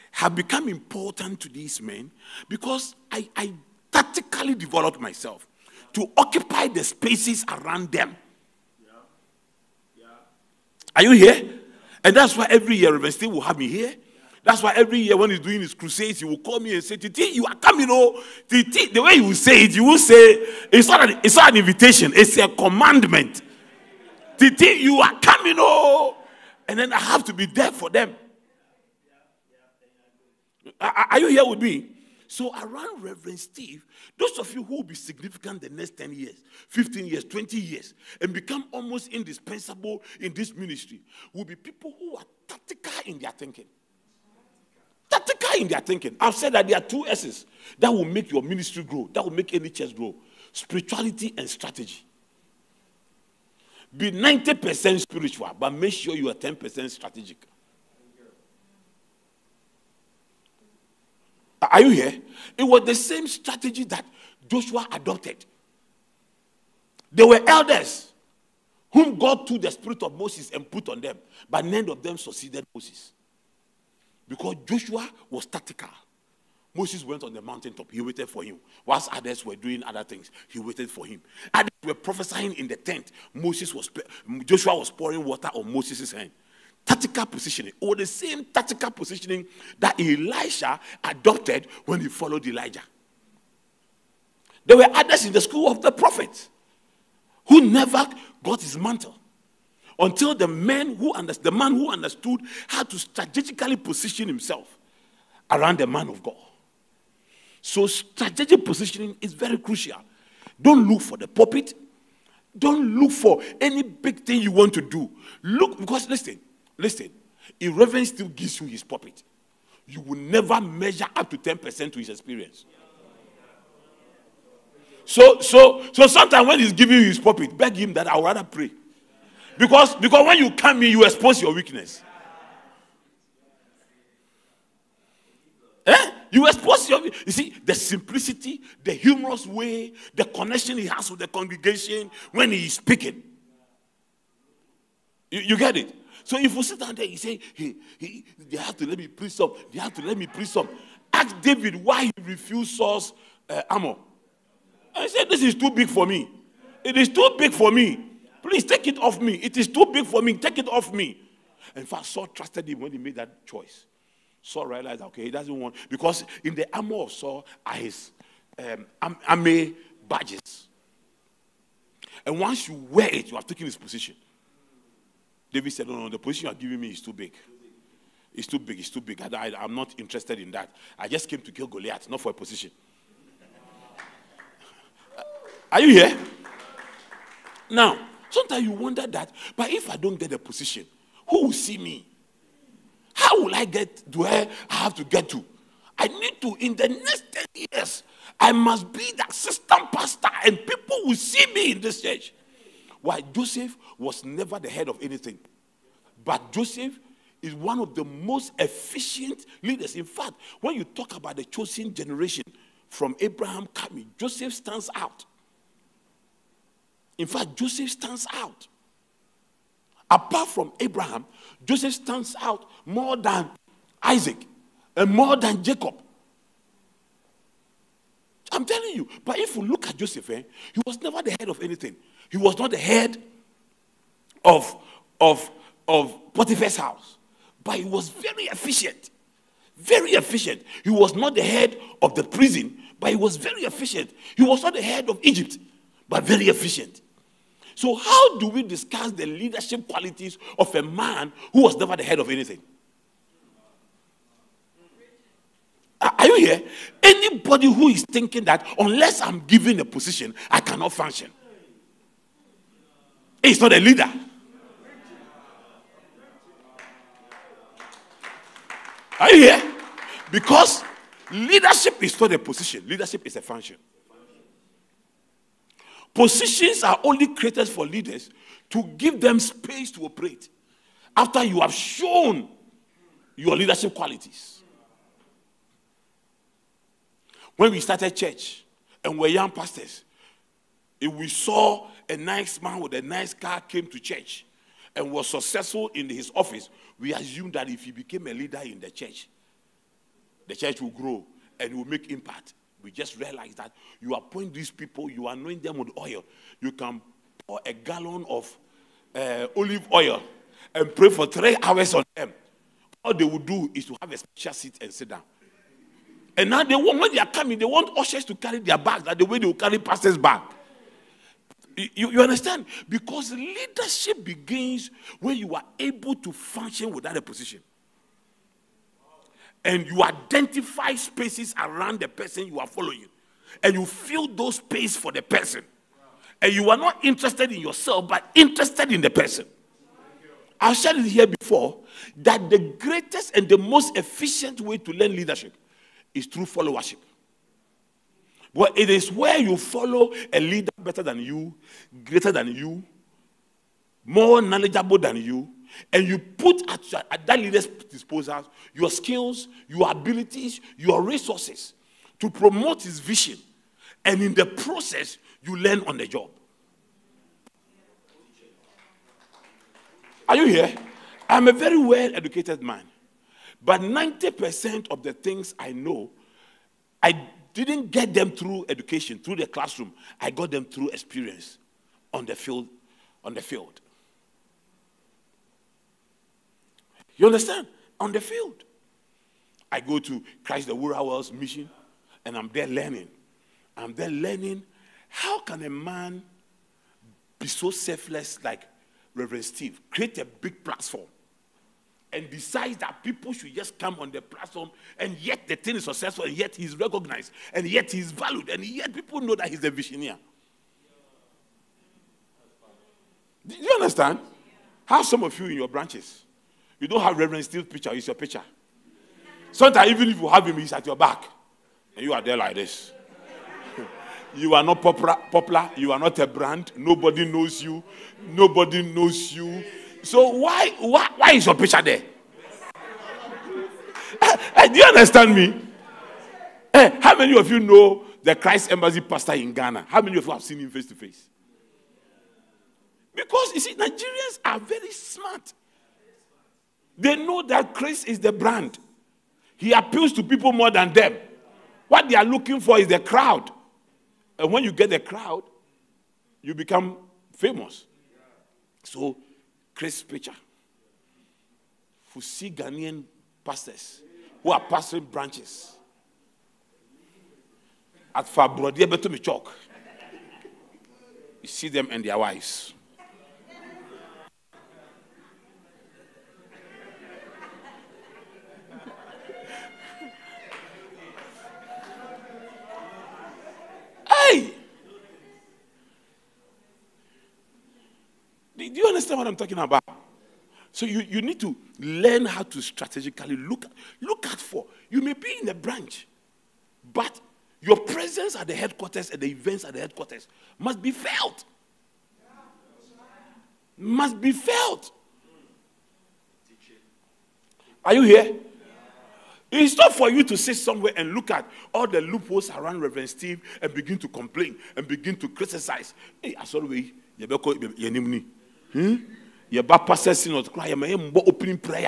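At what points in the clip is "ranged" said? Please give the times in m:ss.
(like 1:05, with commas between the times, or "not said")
not said.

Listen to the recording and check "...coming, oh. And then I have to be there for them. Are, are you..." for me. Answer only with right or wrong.
right.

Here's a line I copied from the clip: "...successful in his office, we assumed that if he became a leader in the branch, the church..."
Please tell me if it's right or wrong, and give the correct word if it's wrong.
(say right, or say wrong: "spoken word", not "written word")
wrong: "church", not "branch".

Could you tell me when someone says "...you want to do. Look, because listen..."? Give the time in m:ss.
1:54.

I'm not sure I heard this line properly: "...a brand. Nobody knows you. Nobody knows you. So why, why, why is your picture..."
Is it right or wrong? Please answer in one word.
right.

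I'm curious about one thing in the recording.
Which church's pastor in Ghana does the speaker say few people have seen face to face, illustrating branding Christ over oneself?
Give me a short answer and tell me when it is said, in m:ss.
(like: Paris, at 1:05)
Christ Embassy, at 7:18.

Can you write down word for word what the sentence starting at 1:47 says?
So, strategic positioning is very crucial.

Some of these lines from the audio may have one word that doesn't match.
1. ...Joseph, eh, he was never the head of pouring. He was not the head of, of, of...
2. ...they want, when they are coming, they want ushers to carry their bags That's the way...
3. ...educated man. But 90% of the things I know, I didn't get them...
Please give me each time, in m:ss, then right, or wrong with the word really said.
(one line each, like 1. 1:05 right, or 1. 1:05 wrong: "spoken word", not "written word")
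1. 3:49 wrong: "anything", not "pouring"
2. 5:16 right
3. 6:12 right.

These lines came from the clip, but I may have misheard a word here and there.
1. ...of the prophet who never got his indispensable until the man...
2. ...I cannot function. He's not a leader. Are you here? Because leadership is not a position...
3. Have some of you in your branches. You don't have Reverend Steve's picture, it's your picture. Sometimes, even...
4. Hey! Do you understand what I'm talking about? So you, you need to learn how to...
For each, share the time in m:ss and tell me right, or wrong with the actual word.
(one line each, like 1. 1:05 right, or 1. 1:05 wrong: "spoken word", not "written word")
1. 1:35 wrong: "mantle", not "indispensable"
2. 4:20 right
3. 6:54 right
4. 8:04 right.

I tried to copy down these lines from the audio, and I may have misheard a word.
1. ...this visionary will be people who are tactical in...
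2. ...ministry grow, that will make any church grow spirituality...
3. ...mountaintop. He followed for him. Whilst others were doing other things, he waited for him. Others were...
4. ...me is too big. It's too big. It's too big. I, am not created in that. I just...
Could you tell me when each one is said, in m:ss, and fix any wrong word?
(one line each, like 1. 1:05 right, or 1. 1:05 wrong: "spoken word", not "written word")
1. 0:40 wrong: "ministry", not "visionary"
2. 0:48 right
3. 1:17 wrong: "waited", not "followed"
4. 2:56 wrong: "interested", not "created".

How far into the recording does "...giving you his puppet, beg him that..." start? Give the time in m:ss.
2:06.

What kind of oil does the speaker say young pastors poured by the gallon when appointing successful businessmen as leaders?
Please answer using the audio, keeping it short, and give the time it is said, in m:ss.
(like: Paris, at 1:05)
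olive oil, at 5:09.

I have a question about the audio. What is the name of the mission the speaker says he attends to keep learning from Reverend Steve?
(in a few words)
Christ the World Hours mission.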